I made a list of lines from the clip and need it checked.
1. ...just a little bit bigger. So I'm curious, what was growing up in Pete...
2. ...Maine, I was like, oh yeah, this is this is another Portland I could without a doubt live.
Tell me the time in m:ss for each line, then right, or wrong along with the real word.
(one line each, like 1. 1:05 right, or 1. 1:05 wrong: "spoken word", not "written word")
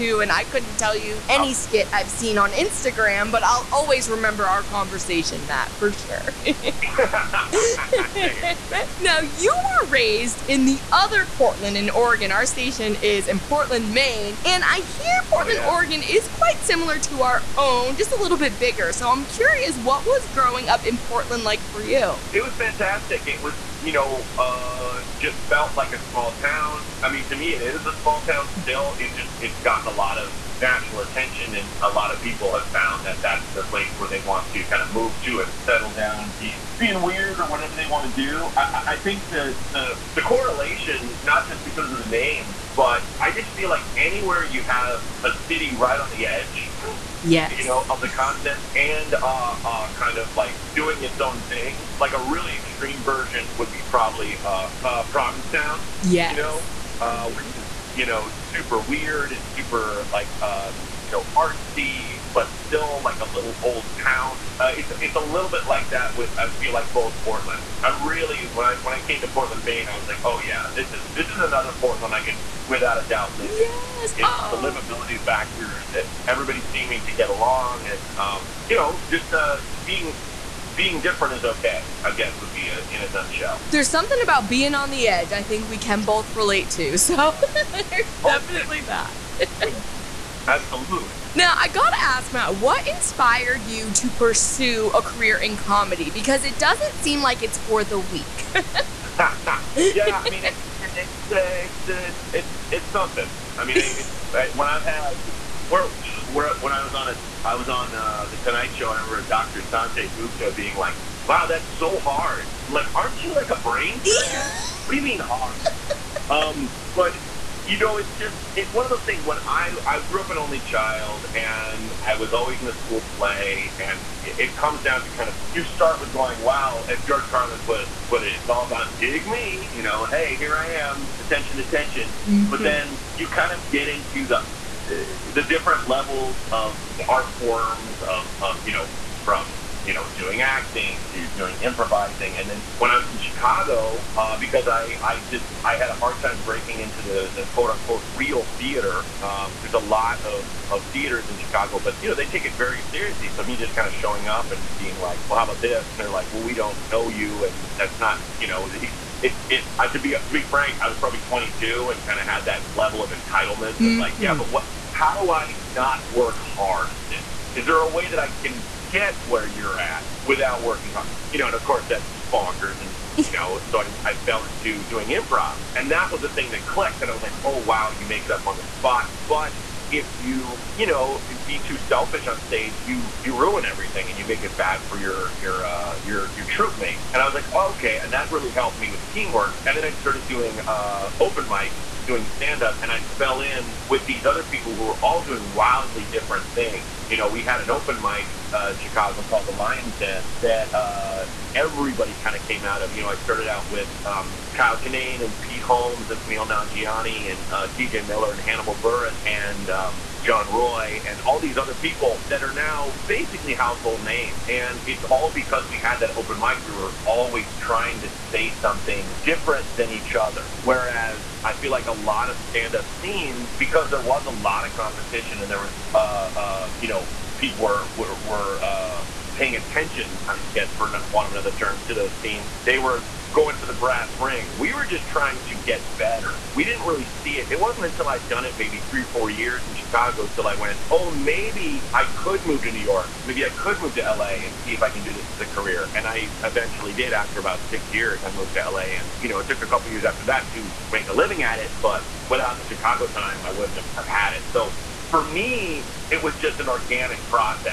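1. 0:17 wrong: "Portland", not "Pete"
2. 1:09 right.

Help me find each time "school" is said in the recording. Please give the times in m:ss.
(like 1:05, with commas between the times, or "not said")
2:02.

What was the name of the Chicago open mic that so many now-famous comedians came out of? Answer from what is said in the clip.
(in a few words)
The Lions Den.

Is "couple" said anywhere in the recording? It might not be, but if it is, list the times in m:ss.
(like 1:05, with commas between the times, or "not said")
4:09.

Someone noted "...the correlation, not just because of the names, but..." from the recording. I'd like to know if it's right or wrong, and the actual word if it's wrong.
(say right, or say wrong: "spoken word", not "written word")
right.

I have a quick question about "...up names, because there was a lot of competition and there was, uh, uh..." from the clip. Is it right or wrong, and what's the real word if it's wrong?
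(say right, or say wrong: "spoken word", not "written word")
wrong: "scenes", not "names".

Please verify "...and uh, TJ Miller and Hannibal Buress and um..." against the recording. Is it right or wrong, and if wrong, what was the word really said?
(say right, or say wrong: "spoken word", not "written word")
right.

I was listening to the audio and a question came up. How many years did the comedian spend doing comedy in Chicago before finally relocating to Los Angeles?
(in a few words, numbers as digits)
6.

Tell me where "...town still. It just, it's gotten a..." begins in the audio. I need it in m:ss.
0:28.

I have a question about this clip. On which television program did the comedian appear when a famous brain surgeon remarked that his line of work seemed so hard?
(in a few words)
The Tonight Show.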